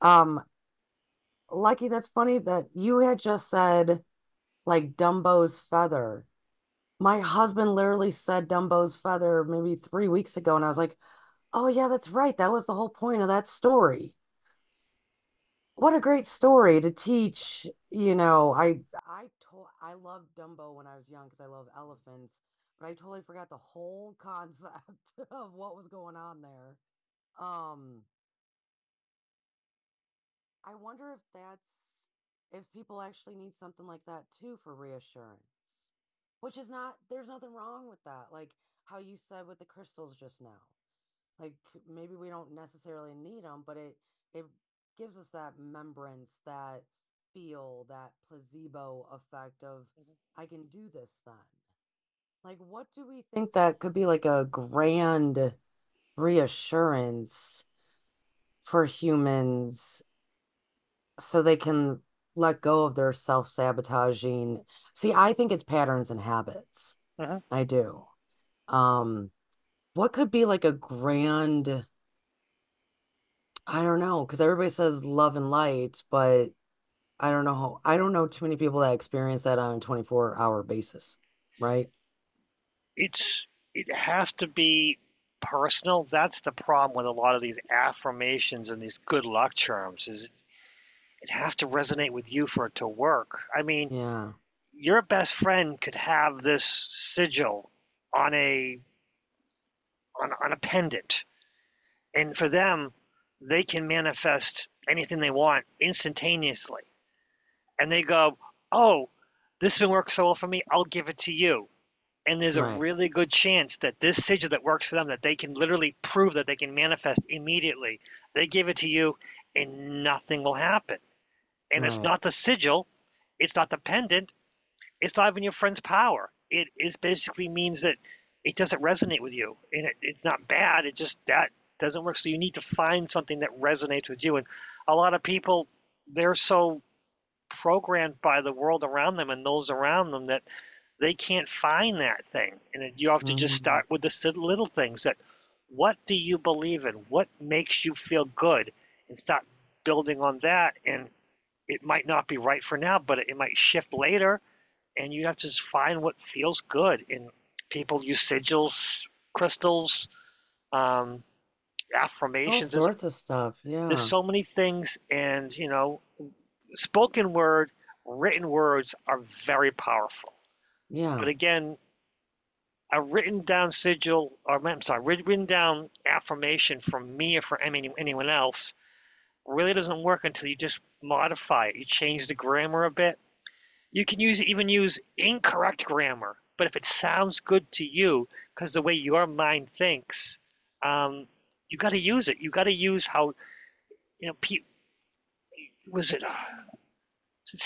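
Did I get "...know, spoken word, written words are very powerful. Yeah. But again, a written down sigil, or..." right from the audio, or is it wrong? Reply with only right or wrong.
right.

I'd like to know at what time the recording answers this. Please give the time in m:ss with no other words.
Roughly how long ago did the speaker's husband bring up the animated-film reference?
0:09.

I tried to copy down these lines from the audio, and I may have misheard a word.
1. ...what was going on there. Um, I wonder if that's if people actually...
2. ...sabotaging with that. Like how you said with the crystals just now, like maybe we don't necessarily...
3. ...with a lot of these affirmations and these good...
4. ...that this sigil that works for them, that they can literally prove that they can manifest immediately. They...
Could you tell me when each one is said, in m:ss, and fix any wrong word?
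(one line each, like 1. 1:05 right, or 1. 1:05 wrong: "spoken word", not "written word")
1. 0:25 right
2. 0:37 wrong: "wrong", not "sabotaging"
3. 1:26 right
4. 1:53 right.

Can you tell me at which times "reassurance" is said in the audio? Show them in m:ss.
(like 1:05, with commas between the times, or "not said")
0:34, 0:56.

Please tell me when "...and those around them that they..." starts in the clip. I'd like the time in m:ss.
2:19.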